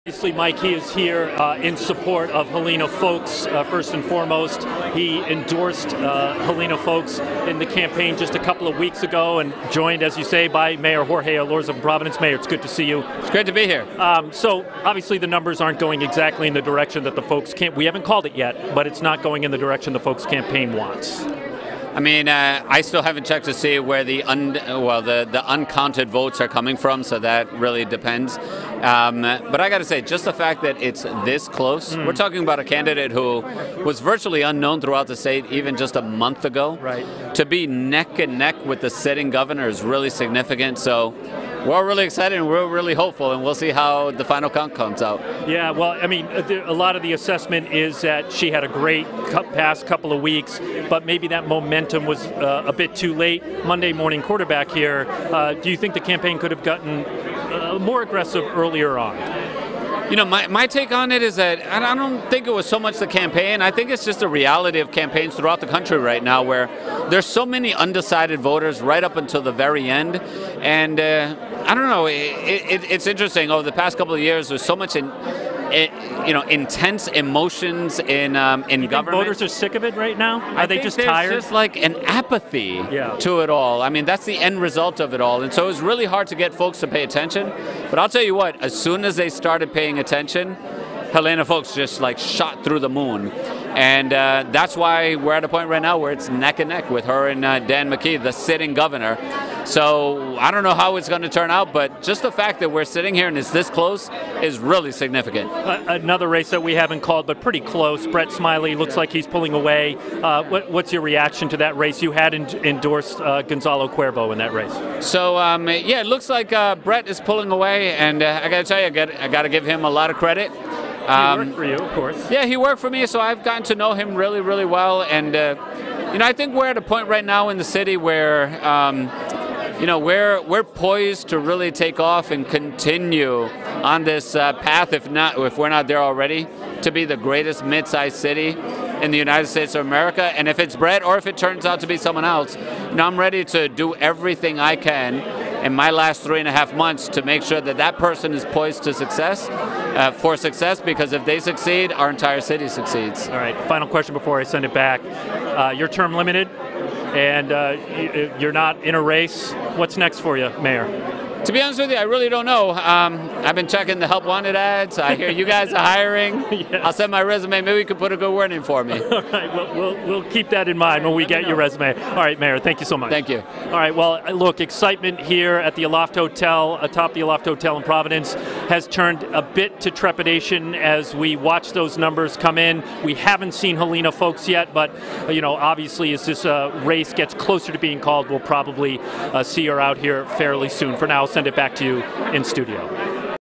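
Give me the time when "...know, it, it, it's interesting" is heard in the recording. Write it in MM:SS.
01:11.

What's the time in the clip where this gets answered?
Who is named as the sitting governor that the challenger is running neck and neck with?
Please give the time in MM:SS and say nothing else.
01:37.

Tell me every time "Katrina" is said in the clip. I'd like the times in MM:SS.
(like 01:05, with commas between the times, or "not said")
not said.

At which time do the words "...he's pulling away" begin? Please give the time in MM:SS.
01:49.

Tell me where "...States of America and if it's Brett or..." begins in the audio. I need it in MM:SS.
02:19.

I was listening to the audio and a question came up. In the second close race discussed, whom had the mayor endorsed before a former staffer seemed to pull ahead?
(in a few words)
Gonzalo Cuervo.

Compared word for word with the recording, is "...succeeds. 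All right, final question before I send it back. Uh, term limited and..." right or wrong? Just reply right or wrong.
right.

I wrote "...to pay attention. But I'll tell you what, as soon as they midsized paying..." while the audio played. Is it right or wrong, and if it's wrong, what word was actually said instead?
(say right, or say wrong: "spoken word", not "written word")
wrong: "started", not "midsized".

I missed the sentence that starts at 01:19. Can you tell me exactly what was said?
voters are sick of it right now.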